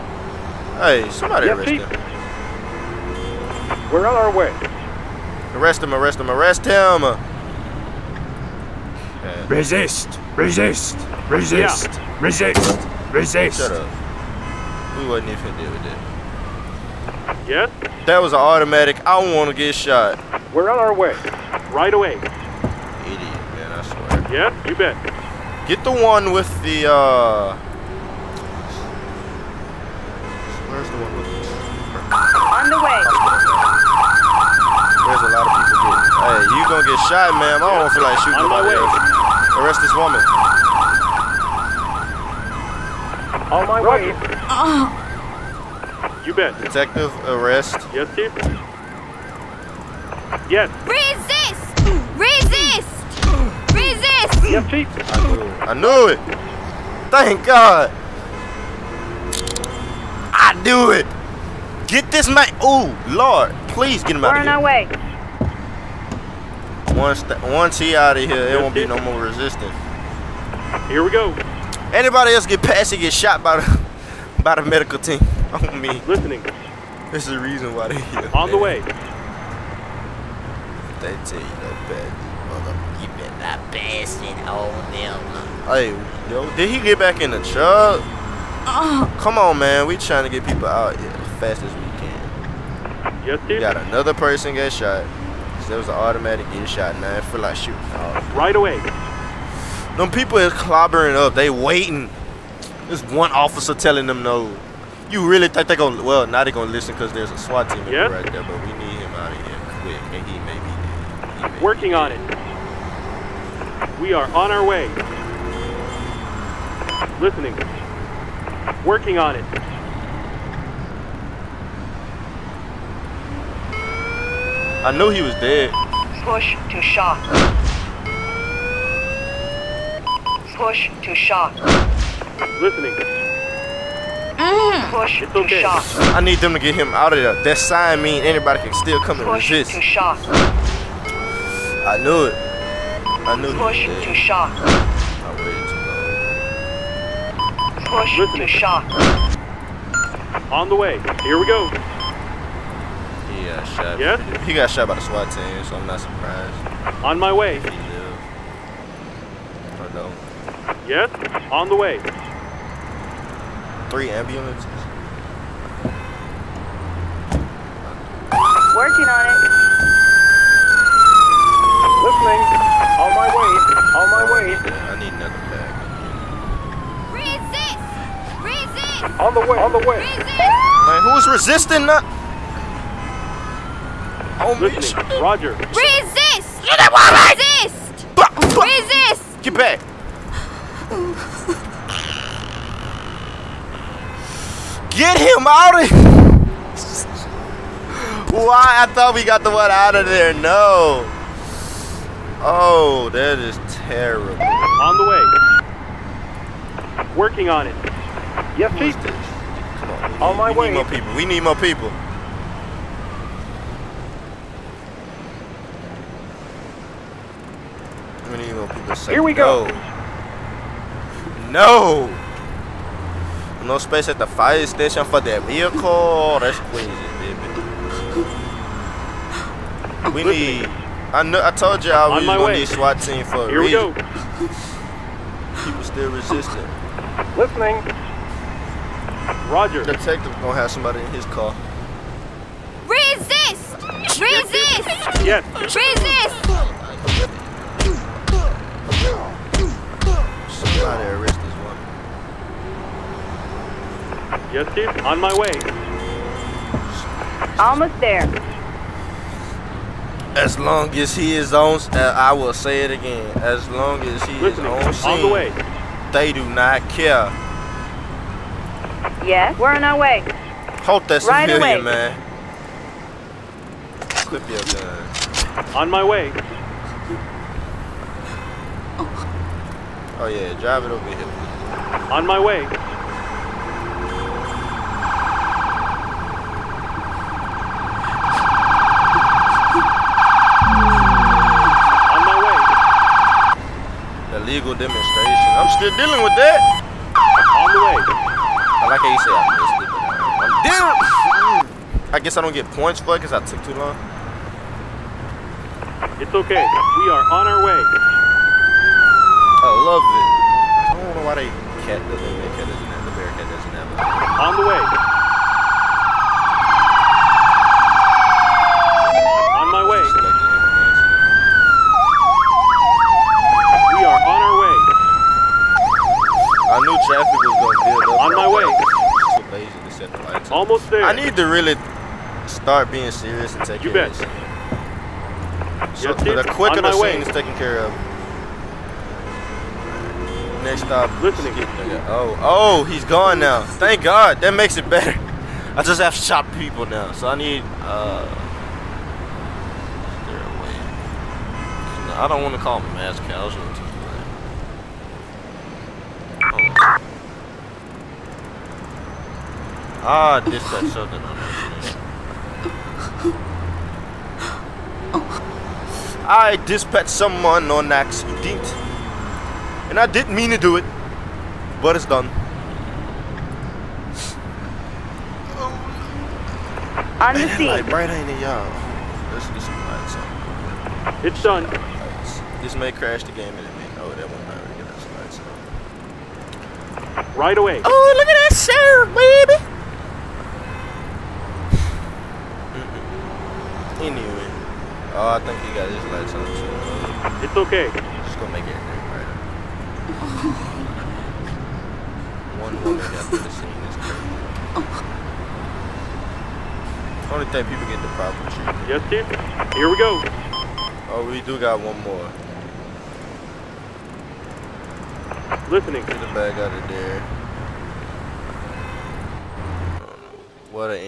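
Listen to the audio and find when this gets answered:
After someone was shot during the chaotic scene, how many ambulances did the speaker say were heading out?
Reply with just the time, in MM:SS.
02:43.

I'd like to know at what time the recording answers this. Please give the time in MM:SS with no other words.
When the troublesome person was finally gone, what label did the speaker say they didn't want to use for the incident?
05:52.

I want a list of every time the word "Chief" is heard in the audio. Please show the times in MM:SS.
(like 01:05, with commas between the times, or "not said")
00:48, 00:54, 03:28.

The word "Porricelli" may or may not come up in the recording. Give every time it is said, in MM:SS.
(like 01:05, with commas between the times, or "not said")
not said.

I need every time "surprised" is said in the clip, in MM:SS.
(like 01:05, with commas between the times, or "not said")
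02:35.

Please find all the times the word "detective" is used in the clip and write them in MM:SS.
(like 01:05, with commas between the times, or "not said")
00:46, 03:59.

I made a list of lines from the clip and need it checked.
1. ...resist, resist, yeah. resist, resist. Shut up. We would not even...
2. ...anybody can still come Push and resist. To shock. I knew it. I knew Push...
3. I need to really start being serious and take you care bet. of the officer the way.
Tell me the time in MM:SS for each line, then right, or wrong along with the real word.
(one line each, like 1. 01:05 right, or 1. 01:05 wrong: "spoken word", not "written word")
1. 00:10 right
2. 02:18 right
3. 05:31 wrong: "quicker", not "officer".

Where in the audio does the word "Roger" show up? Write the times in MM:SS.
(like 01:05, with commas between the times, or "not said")
00:43, 03:05, 03:59.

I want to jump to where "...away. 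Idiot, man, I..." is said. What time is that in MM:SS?
00:21.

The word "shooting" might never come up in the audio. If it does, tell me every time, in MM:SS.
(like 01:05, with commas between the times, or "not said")
00:38, 01:37.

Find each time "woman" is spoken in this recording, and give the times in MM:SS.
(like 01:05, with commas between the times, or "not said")
00:39, 06:42.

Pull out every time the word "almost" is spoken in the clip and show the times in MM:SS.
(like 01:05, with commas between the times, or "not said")
04:17, 05:30.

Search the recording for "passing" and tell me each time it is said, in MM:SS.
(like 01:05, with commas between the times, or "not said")
01:23.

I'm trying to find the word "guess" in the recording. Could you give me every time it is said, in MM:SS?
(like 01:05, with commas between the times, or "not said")
05:02.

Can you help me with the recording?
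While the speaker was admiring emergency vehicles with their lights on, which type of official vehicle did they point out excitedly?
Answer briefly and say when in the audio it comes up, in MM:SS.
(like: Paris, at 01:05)
Sheriff, at 06:28.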